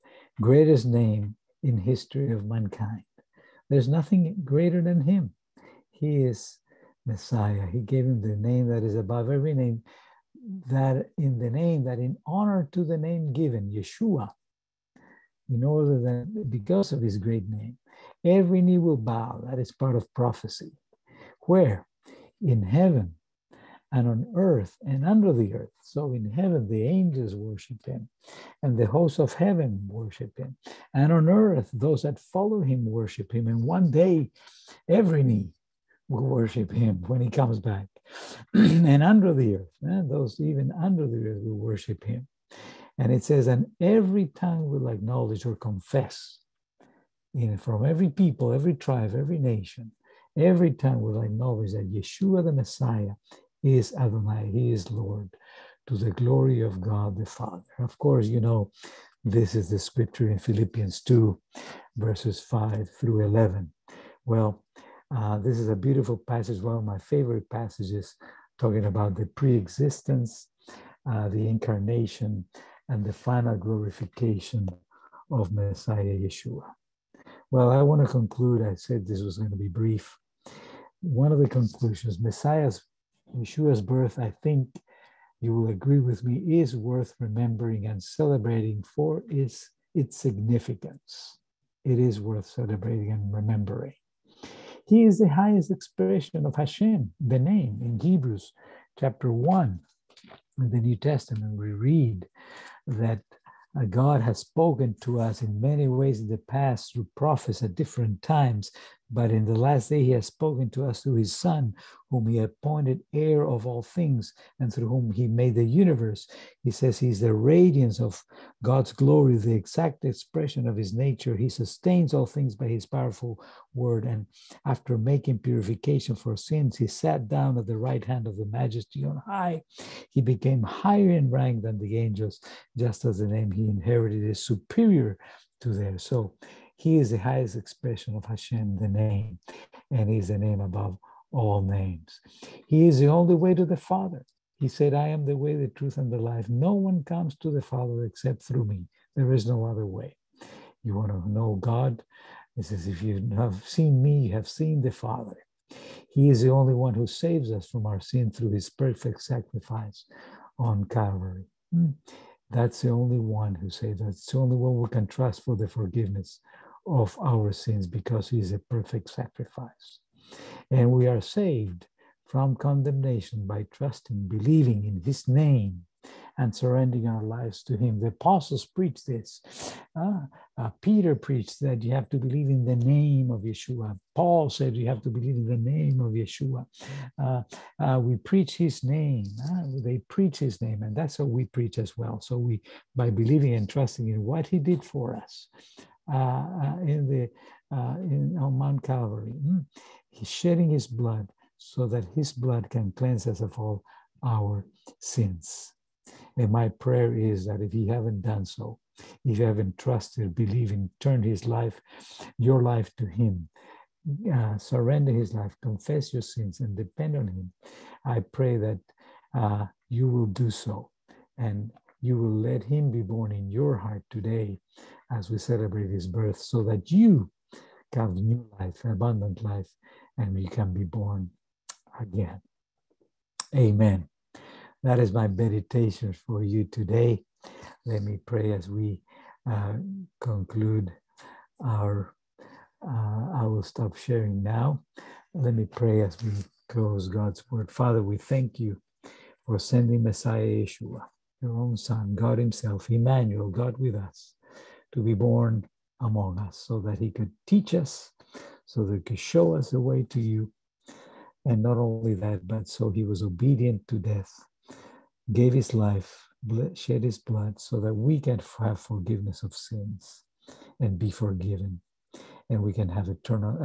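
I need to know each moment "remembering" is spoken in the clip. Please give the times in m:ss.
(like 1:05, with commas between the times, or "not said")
1:27, 1:33.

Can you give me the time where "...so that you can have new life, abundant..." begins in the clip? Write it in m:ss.
3:46.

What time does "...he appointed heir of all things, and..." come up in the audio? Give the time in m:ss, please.
1:52.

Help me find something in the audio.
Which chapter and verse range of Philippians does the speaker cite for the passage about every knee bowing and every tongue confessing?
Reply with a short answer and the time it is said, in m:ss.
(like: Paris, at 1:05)
Philippians 2:5-11, at 1:01.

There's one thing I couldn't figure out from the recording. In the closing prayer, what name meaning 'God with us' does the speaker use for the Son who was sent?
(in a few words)
Emmanuel.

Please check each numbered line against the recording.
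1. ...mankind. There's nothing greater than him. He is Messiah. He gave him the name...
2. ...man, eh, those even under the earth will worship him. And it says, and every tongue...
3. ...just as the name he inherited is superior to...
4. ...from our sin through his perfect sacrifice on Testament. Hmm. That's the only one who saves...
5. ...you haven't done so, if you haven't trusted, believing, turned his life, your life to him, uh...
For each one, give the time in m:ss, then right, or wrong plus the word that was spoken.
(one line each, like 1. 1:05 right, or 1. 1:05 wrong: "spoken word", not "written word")
1. 0:02 right
2. 0:39 right
3. 2:12 right
4. 2:37 wrong: "Calvary", not "Testament"
5. 3:27 right.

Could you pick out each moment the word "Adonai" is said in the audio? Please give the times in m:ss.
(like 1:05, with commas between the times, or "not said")
0:53.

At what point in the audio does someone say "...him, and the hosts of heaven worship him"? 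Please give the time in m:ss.
0:27.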